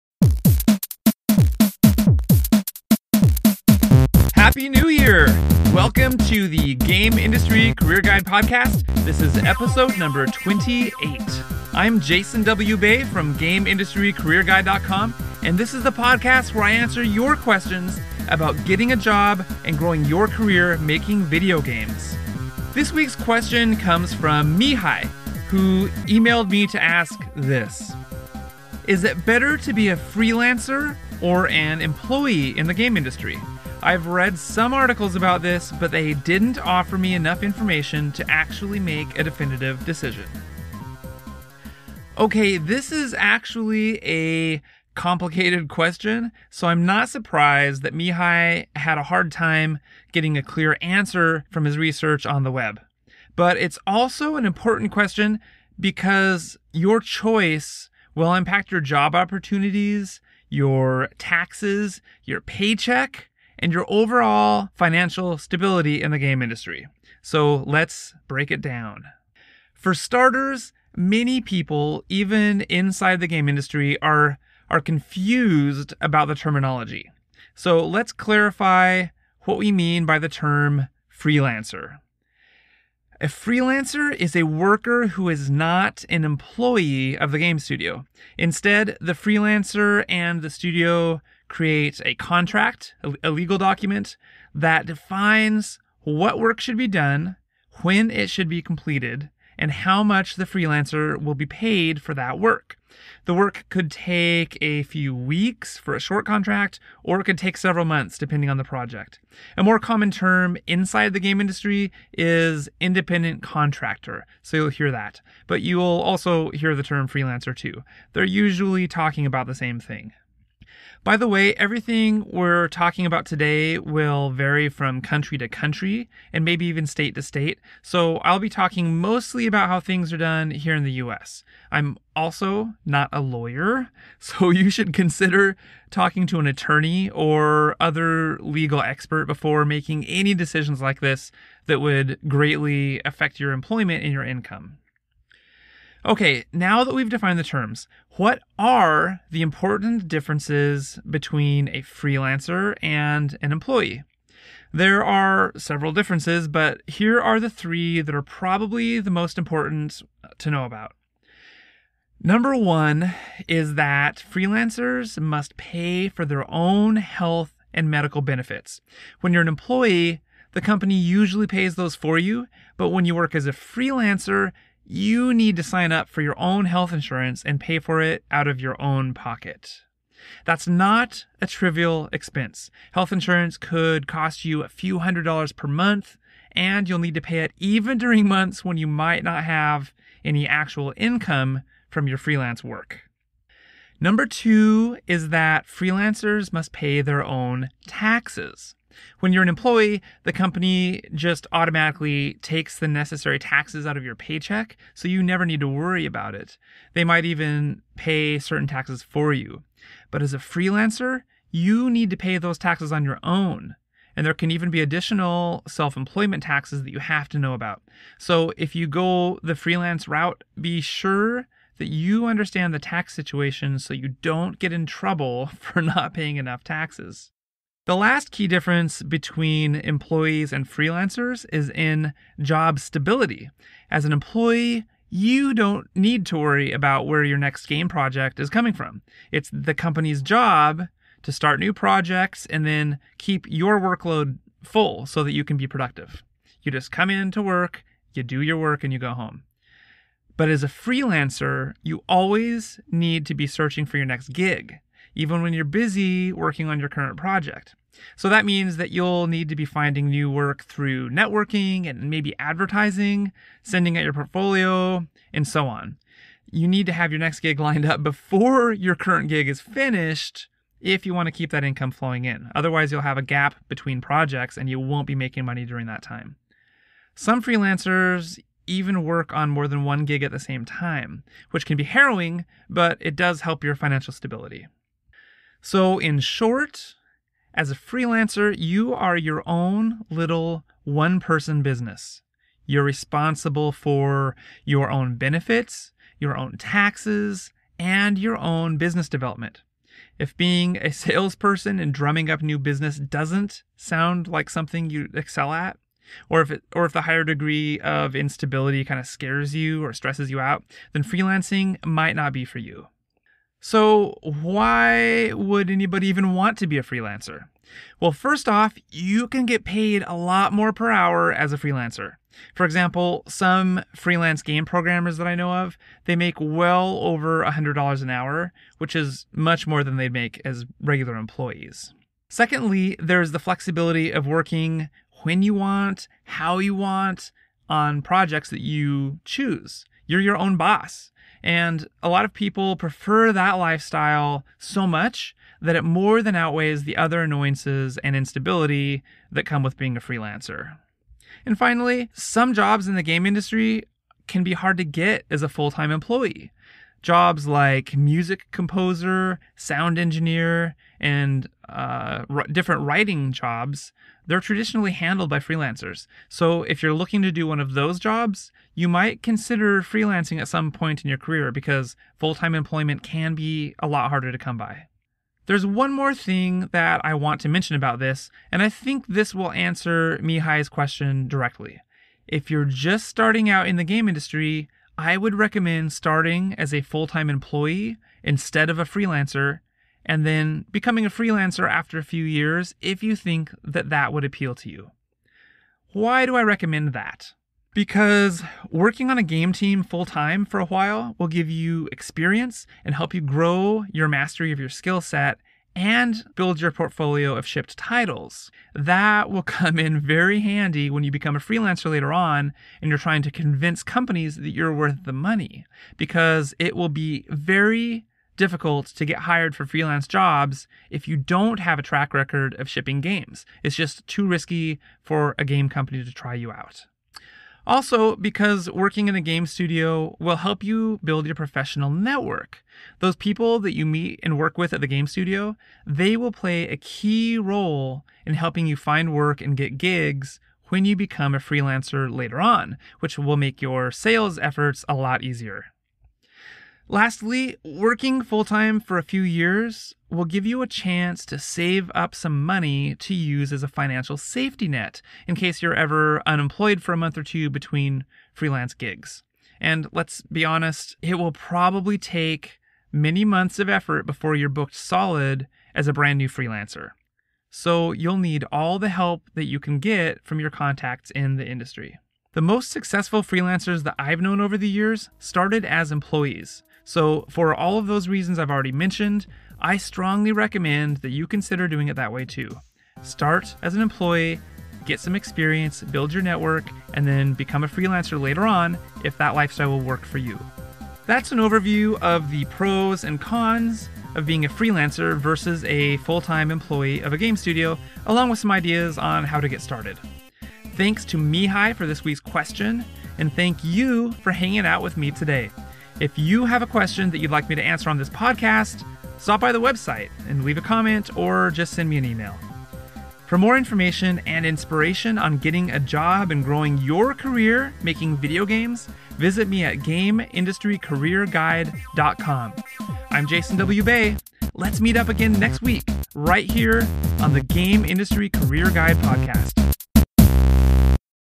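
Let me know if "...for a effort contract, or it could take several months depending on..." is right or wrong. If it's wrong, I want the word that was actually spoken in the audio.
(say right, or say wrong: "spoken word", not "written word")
wrong: "short", not "effort".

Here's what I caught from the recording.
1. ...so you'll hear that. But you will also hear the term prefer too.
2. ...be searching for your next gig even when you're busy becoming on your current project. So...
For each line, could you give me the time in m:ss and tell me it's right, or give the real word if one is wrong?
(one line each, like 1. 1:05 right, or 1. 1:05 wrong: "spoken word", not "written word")
1. 1:54 wrong: "freelancer", not "prefer"
2. 4:13 wrong: "working", not "becoming".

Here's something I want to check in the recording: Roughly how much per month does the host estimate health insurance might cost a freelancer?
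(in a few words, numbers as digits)
a few hundred dollars.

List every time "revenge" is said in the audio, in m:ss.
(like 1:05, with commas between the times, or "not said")
not said.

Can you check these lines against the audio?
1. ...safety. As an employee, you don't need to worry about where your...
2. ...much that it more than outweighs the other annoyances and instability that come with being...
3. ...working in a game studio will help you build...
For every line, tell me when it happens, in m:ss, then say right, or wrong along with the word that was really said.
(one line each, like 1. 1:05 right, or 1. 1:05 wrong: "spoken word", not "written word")
1. 3:52 wrong: "stability", not "safety"
2. 5:44 right
3. 7:08 right.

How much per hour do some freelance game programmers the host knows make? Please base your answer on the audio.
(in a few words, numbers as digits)
over $100.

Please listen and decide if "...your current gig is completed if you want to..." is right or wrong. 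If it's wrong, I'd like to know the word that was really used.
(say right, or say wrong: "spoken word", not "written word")
wrong: "finished", not "completed".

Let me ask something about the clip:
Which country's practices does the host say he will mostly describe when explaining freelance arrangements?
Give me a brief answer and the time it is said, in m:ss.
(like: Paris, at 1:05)
US, at 2:10.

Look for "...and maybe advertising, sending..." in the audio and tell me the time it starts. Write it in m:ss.
4:21.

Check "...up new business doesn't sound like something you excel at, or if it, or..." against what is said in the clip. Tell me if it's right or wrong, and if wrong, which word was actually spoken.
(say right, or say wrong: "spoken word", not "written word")
right.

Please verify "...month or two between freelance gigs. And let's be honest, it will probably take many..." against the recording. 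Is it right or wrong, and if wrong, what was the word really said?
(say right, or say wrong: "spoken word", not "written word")
right.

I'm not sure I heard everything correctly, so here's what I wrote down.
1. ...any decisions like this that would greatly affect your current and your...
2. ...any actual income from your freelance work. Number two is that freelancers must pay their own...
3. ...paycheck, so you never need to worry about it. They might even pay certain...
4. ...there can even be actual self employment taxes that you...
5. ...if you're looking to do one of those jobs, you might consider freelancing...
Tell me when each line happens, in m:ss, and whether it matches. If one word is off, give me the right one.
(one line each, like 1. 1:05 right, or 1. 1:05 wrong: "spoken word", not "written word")
1. 2:20 wrong: "employment", not "current"
2. 3:10 right
3. 3:24 right
4. 3:34 wrong: "additional", not "actual"
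5. 6:06 right.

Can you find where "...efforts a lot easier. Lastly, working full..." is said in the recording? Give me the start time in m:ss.
7:24.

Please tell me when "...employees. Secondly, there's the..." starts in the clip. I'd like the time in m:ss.
5:31.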